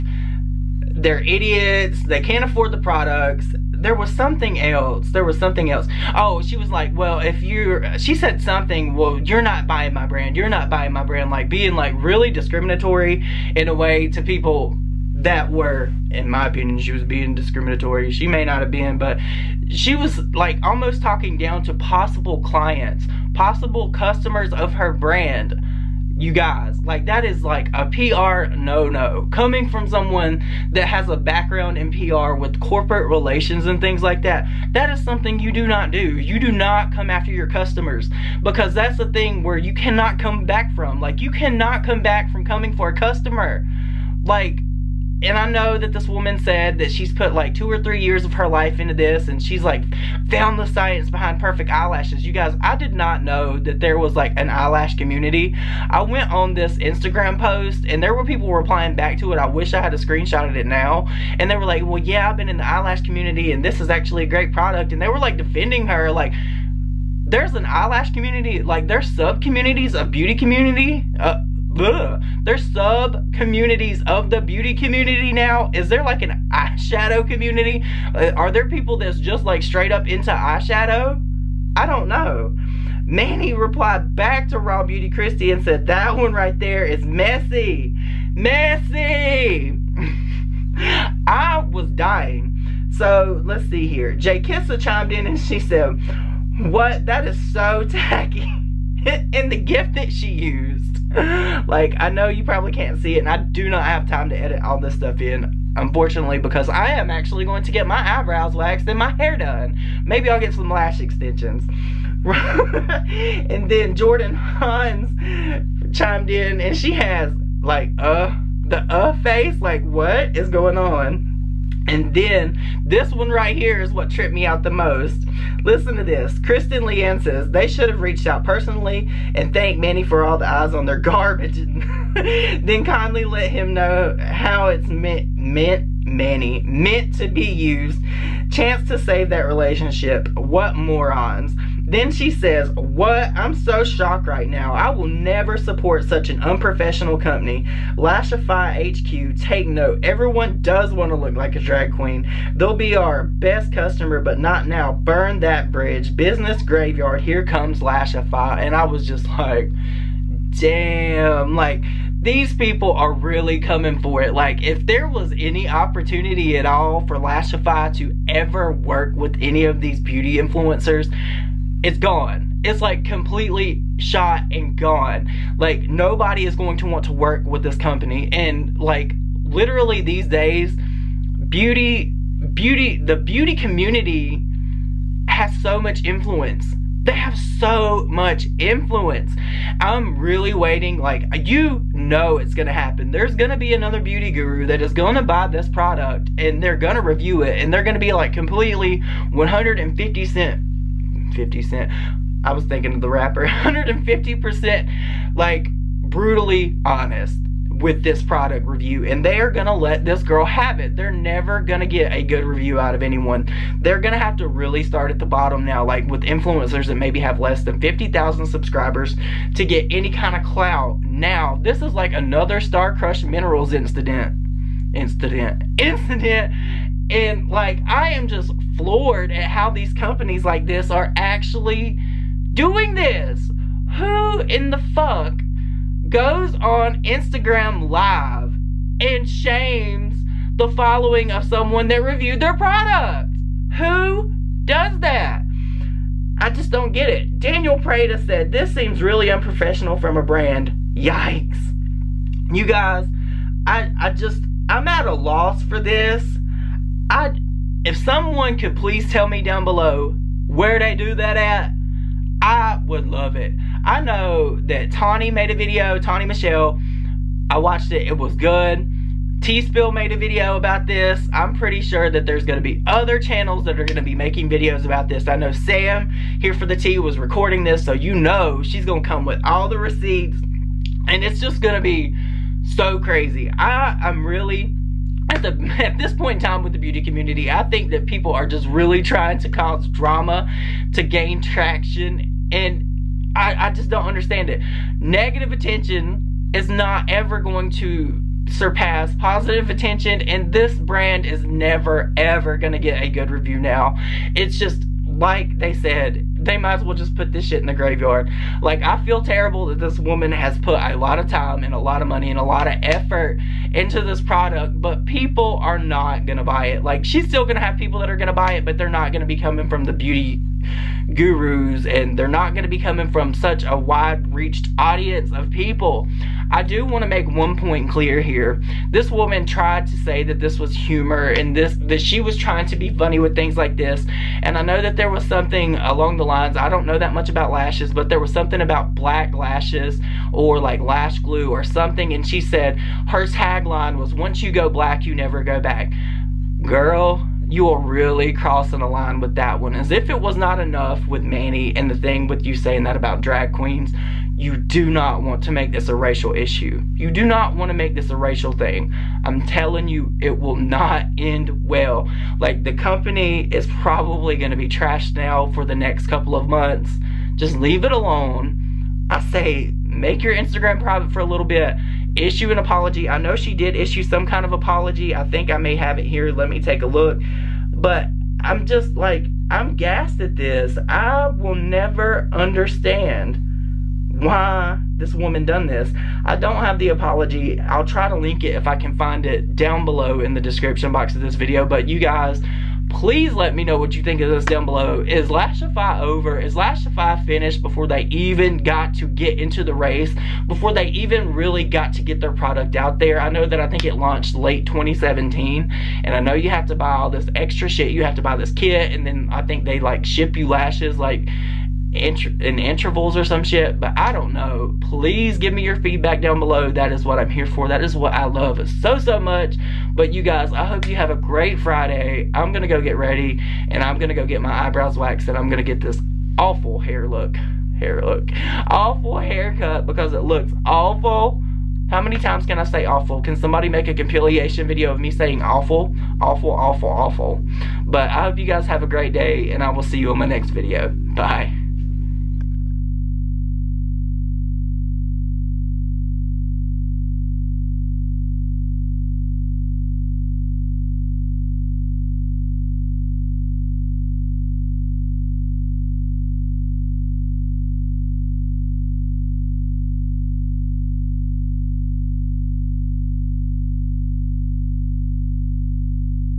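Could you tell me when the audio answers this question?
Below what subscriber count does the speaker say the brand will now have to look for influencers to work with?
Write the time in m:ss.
3:37.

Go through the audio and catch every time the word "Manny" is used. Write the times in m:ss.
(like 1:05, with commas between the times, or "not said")
1:23, 2:09, 5:51.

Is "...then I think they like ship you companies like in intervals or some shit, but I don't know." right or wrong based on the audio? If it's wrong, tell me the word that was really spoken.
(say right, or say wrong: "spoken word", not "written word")
wrong: "lashes", not "companies".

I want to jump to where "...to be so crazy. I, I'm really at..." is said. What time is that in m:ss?
4:41.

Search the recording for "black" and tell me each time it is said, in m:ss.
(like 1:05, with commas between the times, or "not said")
5:38, 5:44.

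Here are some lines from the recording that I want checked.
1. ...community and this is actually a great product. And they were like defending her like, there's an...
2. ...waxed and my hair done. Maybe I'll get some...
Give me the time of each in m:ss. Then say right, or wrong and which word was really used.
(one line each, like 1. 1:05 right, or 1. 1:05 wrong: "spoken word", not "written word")
1. 1:03 right
2. 1:48 right.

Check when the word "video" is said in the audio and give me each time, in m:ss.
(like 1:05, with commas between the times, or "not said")
4:25, 4:30, 4:34, 6:31, 7:14, 7:20.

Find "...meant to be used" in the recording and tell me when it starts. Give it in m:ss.
2:16.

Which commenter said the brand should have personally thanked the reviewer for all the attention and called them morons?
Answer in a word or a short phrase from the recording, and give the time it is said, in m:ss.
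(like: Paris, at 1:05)
Kristen Leanne, at 2:06.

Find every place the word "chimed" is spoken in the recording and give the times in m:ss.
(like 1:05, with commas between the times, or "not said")
1:34, 1:55.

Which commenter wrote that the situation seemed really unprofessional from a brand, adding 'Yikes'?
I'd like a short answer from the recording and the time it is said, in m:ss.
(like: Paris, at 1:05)
Daniel Prada, at 4:07.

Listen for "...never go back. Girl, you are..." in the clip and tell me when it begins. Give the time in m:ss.
5:45.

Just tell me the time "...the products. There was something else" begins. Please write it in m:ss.
0:02.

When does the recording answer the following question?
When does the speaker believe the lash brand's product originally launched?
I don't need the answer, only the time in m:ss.
6:44.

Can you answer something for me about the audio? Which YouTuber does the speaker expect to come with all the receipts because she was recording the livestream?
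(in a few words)
Sam here for the T.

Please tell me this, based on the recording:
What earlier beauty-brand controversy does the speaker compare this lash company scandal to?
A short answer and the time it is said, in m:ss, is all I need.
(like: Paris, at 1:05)
Starcrushed Minerals, at 3:42.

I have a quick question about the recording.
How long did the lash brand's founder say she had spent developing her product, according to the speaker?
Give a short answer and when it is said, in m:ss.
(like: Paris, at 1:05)
2 or 3 years, at 0:47.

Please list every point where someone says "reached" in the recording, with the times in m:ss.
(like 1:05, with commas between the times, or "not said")
2:08, 5:24.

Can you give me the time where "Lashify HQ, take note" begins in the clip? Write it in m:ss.
2:27.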